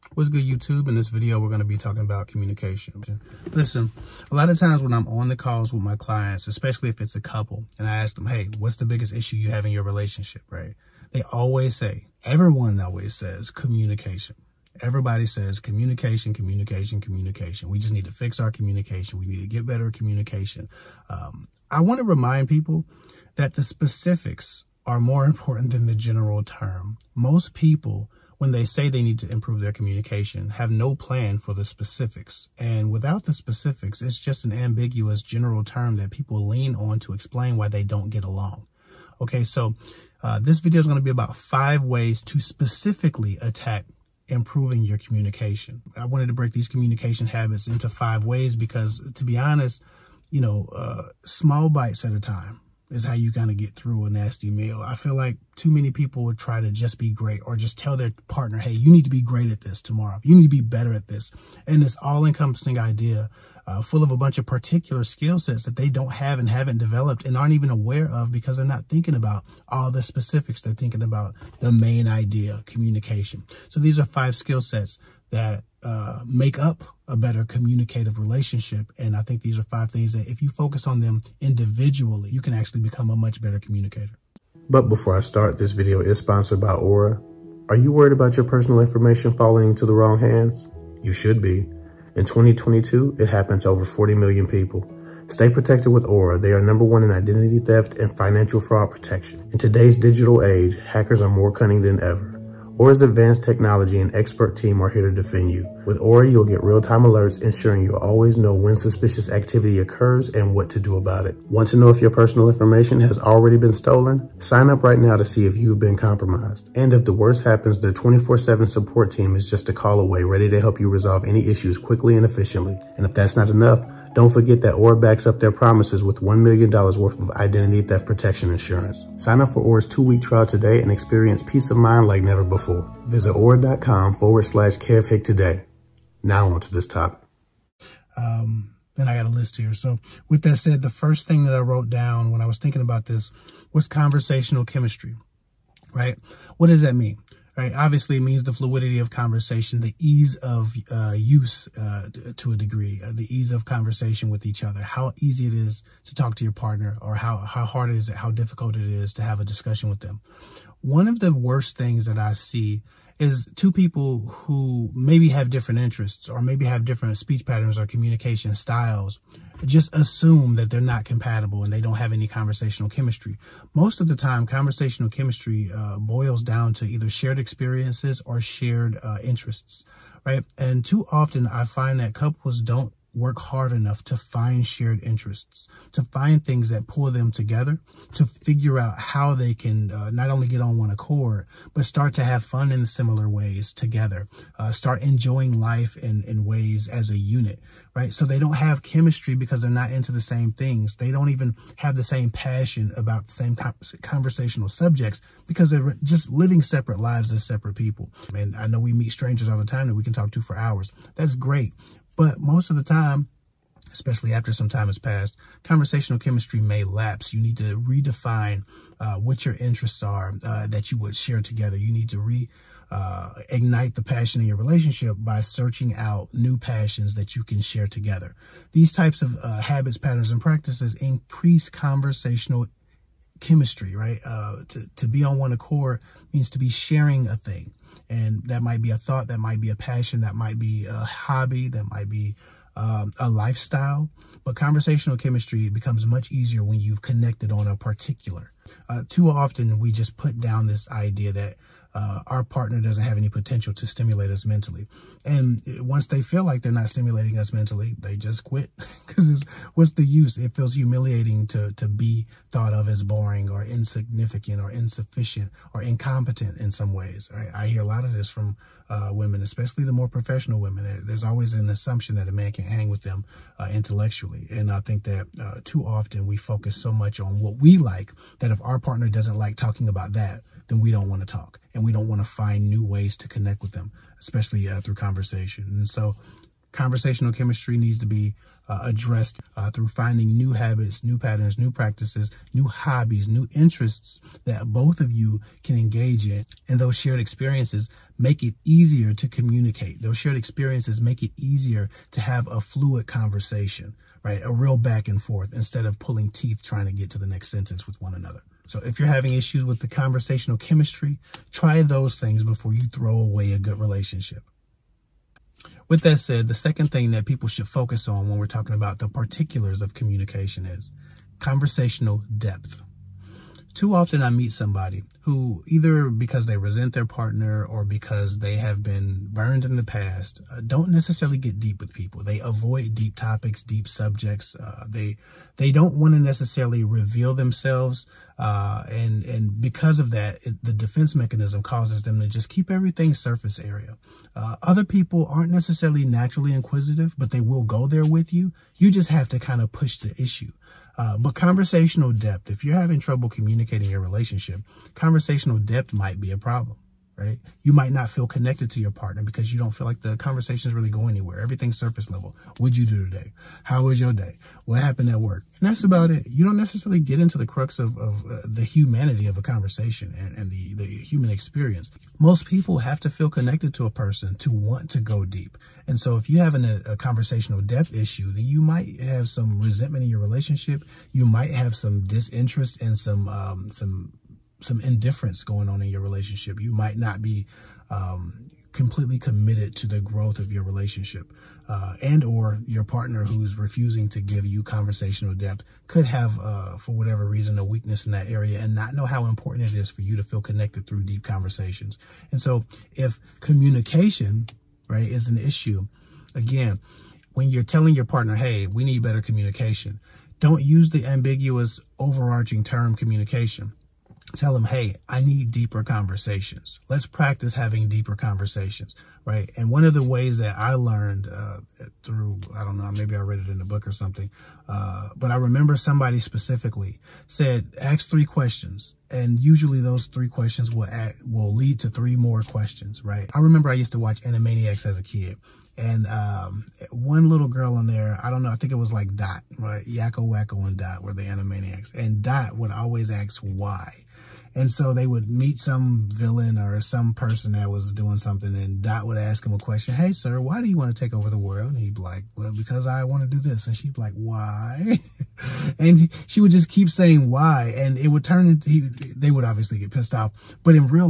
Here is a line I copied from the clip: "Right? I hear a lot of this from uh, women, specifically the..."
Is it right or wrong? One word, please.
wrong.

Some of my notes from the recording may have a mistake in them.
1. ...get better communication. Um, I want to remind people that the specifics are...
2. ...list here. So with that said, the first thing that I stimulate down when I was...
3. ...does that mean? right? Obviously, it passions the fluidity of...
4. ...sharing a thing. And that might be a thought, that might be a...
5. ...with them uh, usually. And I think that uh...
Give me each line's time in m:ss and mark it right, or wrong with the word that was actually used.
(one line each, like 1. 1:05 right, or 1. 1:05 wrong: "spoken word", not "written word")
1. 0:19 right
2. 2:19 wrong: "wrote", not "stimulate"
3. 2:26 wrong: "means", not "passions"
4. 3:56 right
5. 4:32 wrong: "intellectually", not "usually".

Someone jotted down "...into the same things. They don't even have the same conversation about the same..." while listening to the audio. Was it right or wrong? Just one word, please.
wrong.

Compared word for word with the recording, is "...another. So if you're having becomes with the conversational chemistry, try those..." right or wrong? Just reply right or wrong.
wrong.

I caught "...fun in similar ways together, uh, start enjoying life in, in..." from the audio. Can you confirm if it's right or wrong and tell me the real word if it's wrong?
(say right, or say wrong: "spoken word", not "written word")
right.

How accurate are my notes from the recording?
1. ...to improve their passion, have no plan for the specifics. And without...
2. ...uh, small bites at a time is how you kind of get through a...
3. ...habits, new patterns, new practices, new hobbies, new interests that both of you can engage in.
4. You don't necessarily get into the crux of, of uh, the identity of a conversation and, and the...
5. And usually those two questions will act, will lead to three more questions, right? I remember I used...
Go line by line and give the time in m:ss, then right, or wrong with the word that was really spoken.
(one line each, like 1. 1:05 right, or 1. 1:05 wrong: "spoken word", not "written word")
1. 0:29 wrong: "communication", not "passion"
2. 0:50 right
3. 4:50 right
4. 6:06 wrong: "humanity", not "identity"
5. 7:09 wrong: "three", not "two".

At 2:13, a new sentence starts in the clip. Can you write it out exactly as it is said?
Visit auracom forward slash KevHick today.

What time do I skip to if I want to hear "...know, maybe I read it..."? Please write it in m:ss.
7:02.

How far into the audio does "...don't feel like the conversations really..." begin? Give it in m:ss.
5:59.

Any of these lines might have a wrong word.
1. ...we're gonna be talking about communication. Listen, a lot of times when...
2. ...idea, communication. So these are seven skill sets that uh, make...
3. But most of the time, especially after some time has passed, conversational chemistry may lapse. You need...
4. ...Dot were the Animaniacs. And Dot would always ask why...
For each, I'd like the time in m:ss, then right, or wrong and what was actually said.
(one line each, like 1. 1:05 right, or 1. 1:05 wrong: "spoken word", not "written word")
1. 0:01 right
2. 1:12 wrong: "five", not "seven"
3. 3:32 right
4. 7:20 right.